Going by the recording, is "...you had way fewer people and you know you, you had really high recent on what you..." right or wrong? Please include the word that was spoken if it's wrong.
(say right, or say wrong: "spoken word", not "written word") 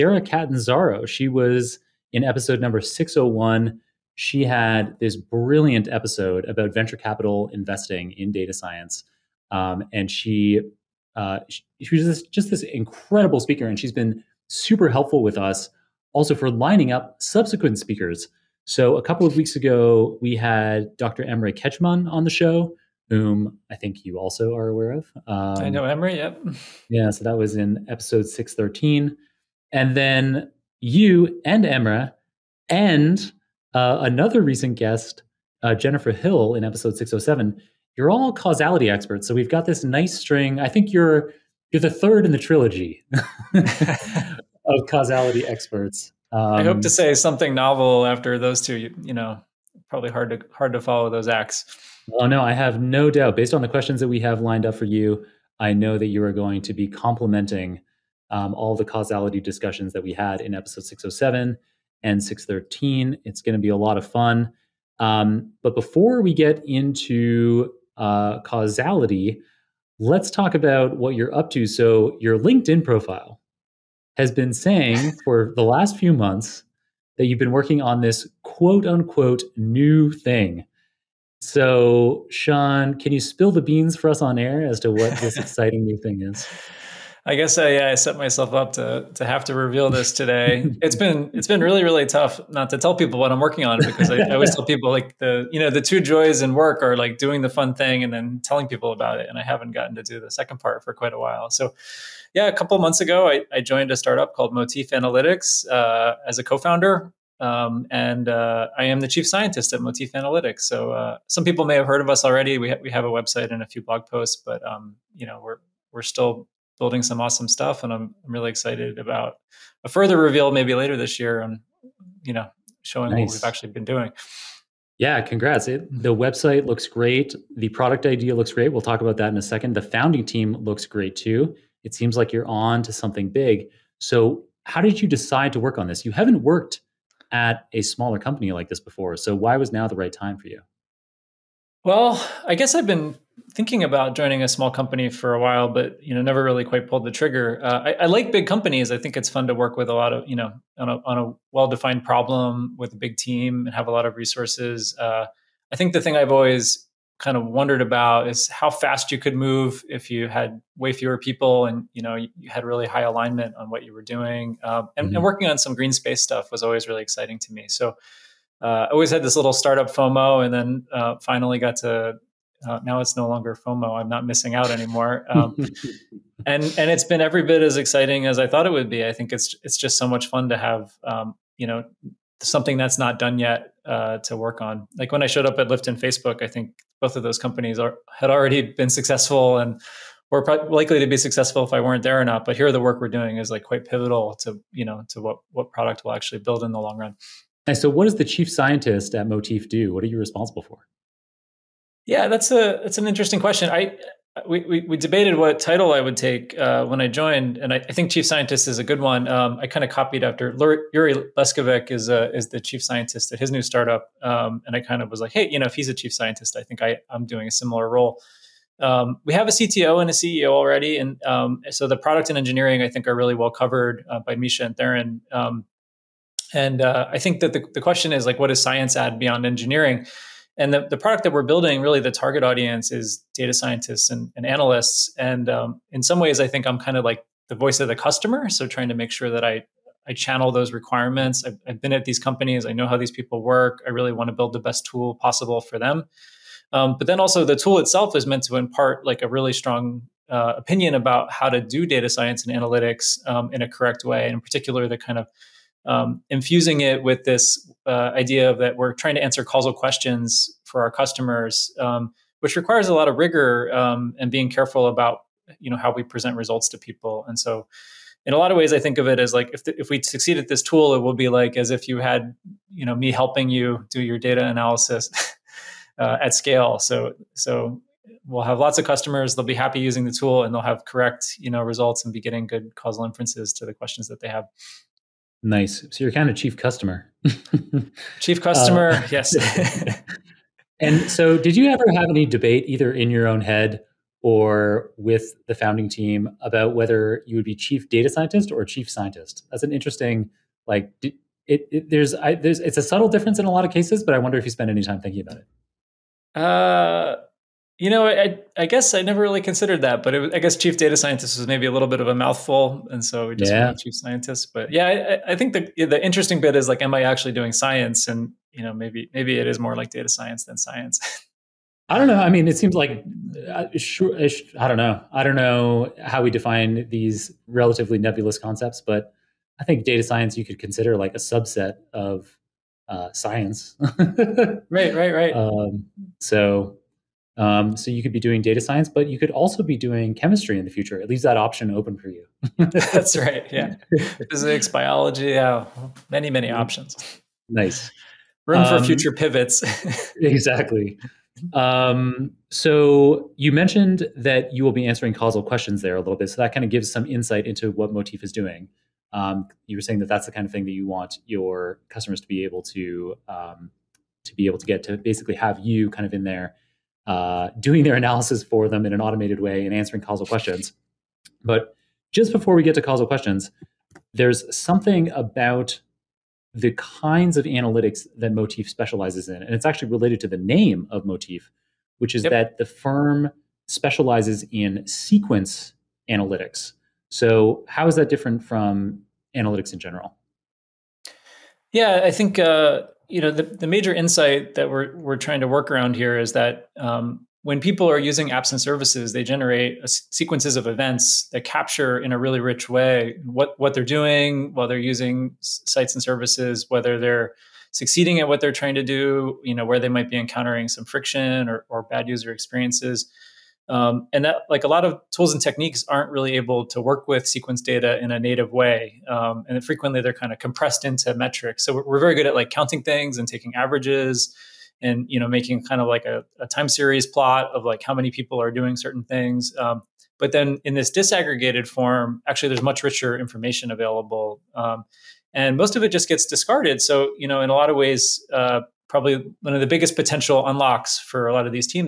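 wrong: "alignment", not "recent".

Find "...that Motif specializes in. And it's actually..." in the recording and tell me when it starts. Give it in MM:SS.
06:18.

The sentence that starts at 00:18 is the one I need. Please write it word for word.
So a couple of weeks ago, we had Dr.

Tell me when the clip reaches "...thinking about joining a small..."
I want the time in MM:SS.
02:23.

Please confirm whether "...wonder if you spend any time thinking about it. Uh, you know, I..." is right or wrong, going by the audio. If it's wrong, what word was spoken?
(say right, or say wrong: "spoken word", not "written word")
right.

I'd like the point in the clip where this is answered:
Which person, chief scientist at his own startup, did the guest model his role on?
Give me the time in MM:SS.
03:30.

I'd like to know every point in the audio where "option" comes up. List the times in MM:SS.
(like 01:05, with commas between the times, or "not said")
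05:41, 05:46.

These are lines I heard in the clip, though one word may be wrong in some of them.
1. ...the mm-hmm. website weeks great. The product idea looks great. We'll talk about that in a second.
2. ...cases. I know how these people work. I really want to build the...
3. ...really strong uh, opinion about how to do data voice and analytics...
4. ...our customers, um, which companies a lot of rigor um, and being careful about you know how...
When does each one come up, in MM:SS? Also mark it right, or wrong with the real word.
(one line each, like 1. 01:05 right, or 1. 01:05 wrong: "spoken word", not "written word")
1. 02:05 wrong: "looks", not "weeks"
2. 04:02 wrong: "companies", not "cases"
3. 04:09 wrong: "science", not "voice"
4. 04:20 wrong: "requires", not "companies".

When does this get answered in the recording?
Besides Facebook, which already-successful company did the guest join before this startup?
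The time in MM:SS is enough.
03:05.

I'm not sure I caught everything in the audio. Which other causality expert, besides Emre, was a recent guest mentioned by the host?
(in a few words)
Jennifer Hill.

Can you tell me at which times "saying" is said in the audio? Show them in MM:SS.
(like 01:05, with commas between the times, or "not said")
01:14, 05:59.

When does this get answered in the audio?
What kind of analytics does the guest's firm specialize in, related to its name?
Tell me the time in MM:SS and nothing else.
06:24.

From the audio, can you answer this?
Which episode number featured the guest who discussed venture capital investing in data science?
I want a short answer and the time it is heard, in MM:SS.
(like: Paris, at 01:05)
601, at 00:02.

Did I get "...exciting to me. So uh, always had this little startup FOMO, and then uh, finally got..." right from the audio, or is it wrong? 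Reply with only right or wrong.
right.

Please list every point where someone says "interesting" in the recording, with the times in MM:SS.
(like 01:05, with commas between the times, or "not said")
03:23, 04:59, 05:16.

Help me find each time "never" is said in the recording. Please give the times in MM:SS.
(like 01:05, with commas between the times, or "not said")
02:26, 05:09.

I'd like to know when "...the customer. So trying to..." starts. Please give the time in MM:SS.
03:57.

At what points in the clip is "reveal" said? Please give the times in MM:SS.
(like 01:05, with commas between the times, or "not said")
01:29, 02:00.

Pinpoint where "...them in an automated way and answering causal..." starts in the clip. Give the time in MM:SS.
06:08.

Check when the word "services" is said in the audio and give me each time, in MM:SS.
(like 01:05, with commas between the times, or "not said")
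06:38, 06:46.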